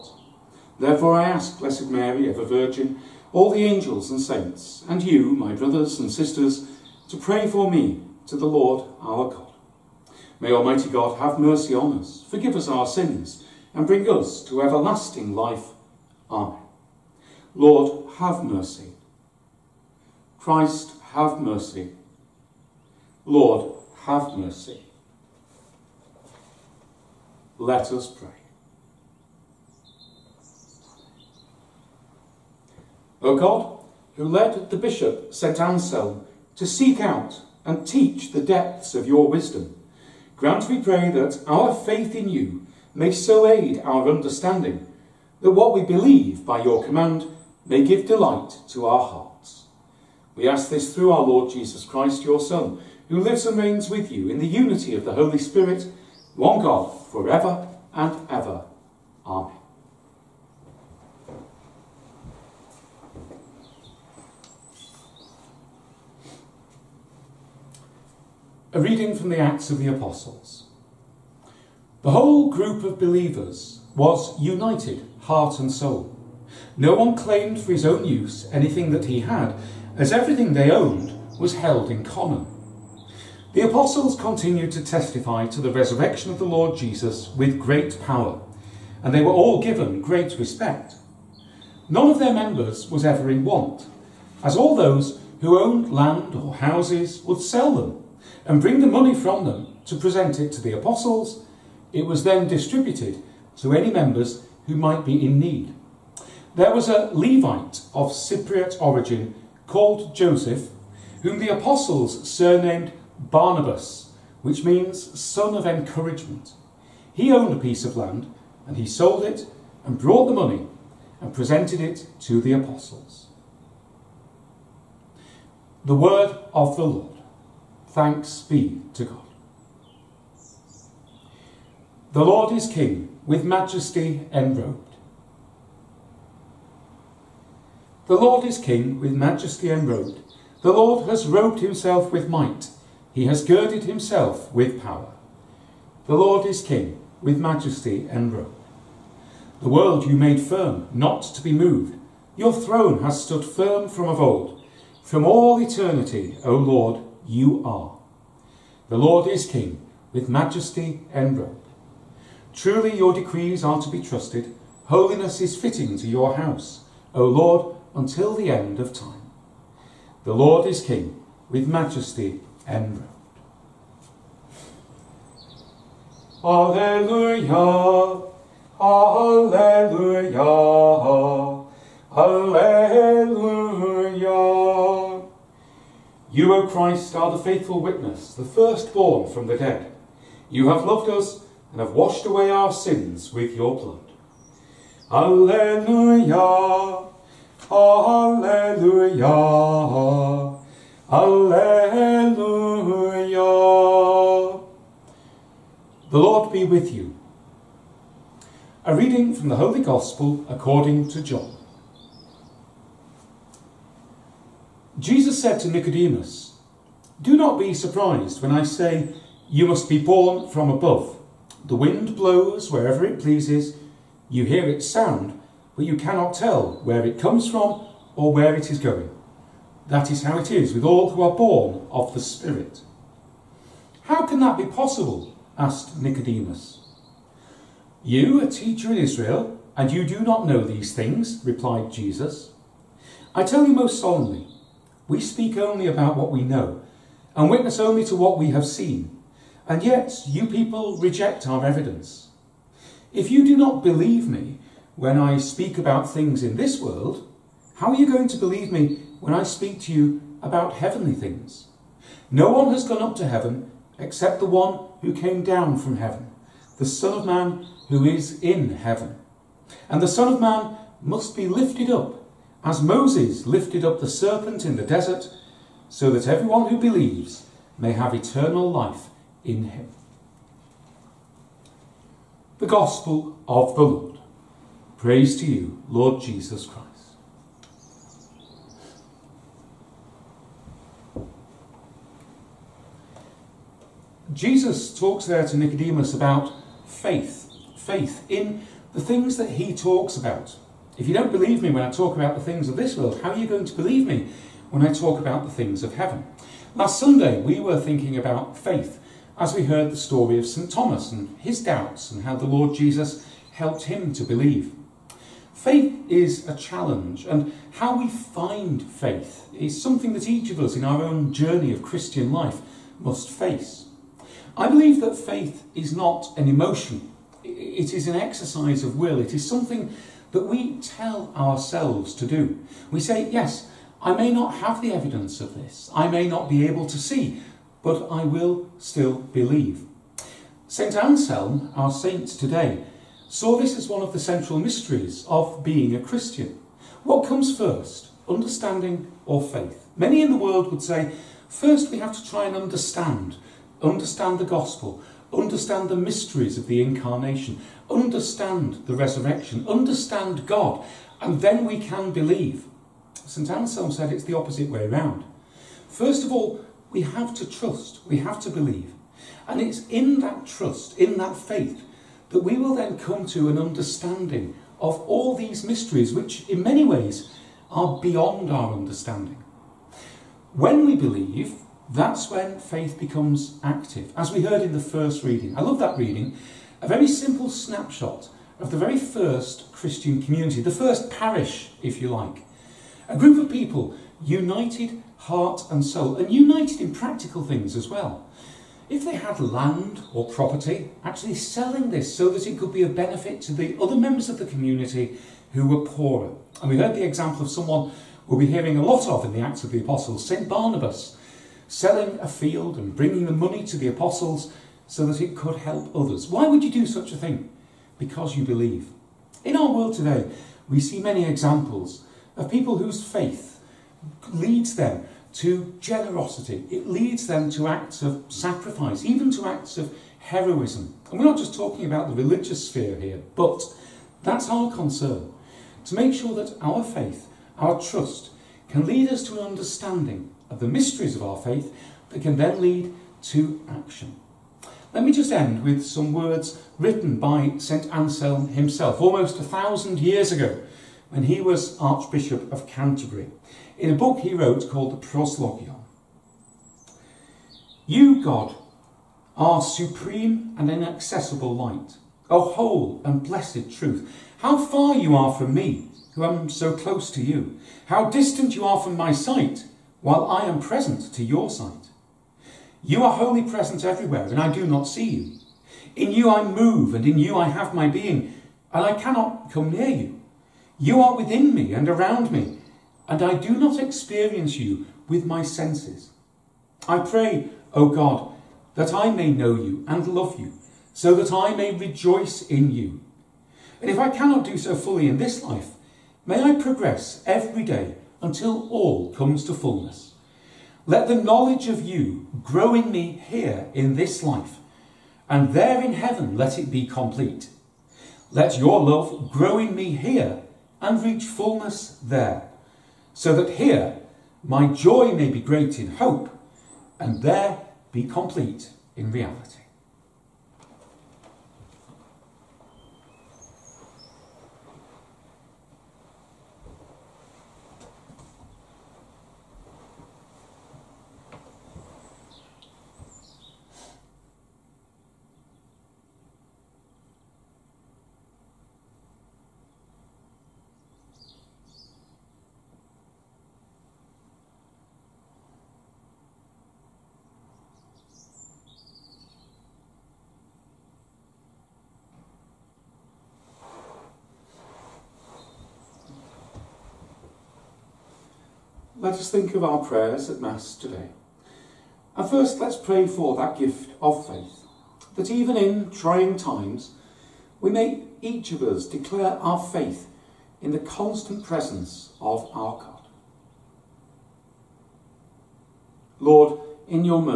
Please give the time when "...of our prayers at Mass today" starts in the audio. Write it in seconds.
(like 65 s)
559 s.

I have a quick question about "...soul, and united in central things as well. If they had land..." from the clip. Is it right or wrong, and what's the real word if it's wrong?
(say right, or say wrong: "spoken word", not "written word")
wrong: "practical", not "central".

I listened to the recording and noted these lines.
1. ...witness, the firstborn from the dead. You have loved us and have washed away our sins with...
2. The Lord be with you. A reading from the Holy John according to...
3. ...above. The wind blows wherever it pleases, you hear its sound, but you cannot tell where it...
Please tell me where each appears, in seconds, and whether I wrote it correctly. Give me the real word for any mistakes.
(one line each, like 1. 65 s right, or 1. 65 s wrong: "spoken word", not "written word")
1. 187 s right
2. 206 s wrong: "Gospel", not "John"
3. 220 s right.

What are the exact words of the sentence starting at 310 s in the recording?
Thomas and his doubts and how the Lord Jesus helped him to believe.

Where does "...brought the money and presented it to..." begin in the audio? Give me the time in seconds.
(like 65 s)
119 s.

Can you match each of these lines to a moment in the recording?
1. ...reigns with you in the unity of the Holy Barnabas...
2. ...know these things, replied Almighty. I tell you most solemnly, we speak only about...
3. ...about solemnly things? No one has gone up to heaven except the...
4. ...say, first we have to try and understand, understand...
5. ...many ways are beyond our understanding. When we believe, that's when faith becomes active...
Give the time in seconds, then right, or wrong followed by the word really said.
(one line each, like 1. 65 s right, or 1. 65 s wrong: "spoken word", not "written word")
1. 53 s wrong: "Spirit", not "Barnabas"
2. 240 s wrong: "Jesus", not "Almighty"
3. 260 s wrong: "heavenly", not "solemnly"
4. 350 s right
5. 376 s right.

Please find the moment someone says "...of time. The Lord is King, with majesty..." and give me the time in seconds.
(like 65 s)
168 s.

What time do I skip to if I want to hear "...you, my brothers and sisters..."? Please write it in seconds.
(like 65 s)
5 s.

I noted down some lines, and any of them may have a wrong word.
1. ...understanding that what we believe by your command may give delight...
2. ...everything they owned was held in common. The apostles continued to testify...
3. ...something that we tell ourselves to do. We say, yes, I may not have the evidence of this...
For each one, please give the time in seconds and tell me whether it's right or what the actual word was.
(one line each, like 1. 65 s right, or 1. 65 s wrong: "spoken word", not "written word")
1. 44 s right
2. 80 s right
3. 329 s right.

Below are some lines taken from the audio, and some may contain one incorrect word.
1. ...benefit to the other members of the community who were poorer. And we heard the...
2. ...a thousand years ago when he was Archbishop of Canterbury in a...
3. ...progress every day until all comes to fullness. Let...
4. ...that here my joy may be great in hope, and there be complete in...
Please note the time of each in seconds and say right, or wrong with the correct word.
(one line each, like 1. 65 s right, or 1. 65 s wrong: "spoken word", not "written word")
1. 402 s right
2. 449 s right
3. 496 s right
4. 513 s right.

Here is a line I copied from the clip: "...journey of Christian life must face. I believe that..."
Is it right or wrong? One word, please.
right.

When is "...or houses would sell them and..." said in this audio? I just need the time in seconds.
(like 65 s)
96 s.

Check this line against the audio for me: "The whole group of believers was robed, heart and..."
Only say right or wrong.
wrong.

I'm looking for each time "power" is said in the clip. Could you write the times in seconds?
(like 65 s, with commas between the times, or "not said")
88 s, 144 s.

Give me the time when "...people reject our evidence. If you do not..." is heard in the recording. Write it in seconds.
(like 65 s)
250 s.